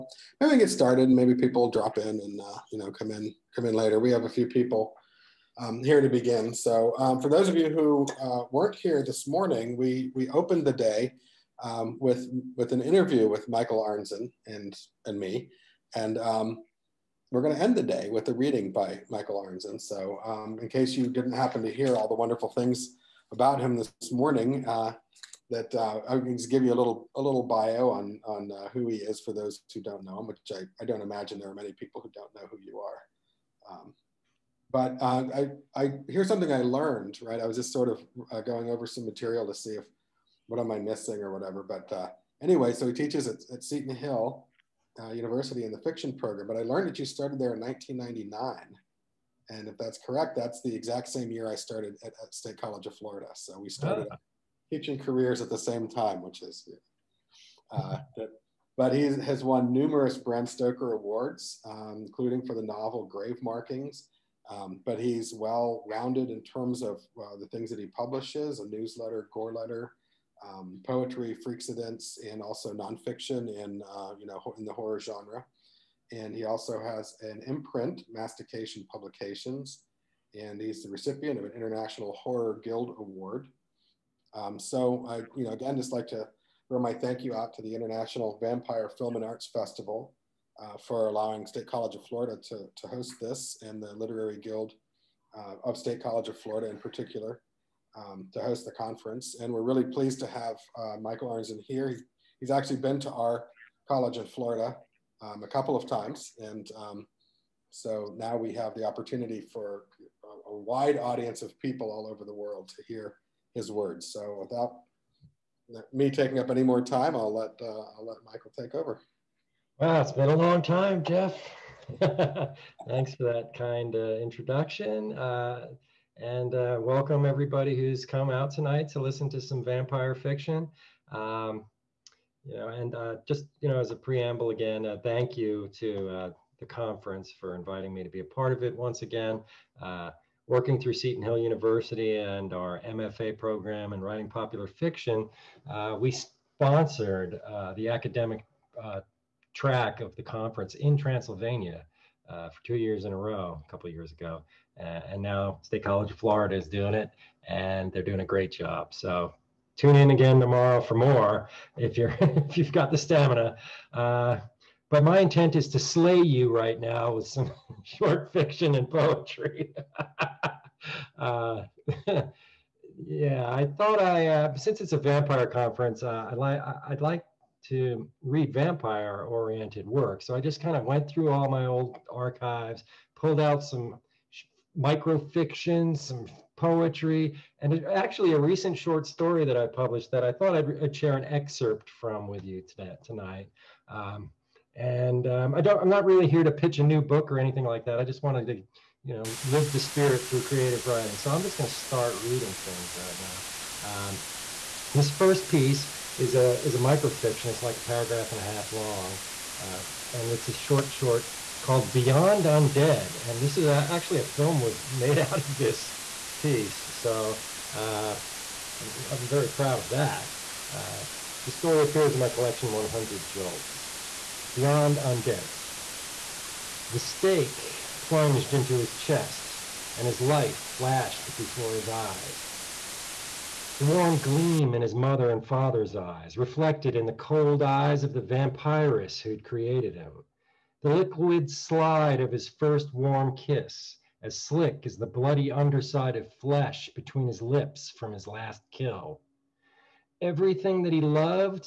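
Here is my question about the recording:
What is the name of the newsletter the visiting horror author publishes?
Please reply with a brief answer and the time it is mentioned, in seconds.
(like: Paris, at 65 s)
Goreletter, at 69 s.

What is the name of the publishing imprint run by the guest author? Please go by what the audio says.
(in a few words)
Mastication Publications.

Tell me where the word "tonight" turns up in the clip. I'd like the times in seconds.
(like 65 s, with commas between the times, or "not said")
128 s, 193 s.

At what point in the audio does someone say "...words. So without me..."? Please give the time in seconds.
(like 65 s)
113 s.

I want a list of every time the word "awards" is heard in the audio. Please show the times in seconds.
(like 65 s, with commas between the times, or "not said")
60 s, 82 s.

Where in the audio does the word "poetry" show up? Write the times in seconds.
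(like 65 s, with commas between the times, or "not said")
70 s, 168 s, 186 s.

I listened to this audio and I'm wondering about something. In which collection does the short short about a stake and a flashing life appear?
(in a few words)
100 Jolts.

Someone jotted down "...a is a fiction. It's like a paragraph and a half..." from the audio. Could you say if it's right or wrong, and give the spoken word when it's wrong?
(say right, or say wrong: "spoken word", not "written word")
wrong: "microfiction", not "fiction".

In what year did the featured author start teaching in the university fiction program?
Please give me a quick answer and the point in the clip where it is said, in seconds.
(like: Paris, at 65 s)
1999, at 47 s.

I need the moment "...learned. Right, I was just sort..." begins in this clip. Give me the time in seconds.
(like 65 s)
36 s.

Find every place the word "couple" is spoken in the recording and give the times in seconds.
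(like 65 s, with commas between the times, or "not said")
105 s, 153 s.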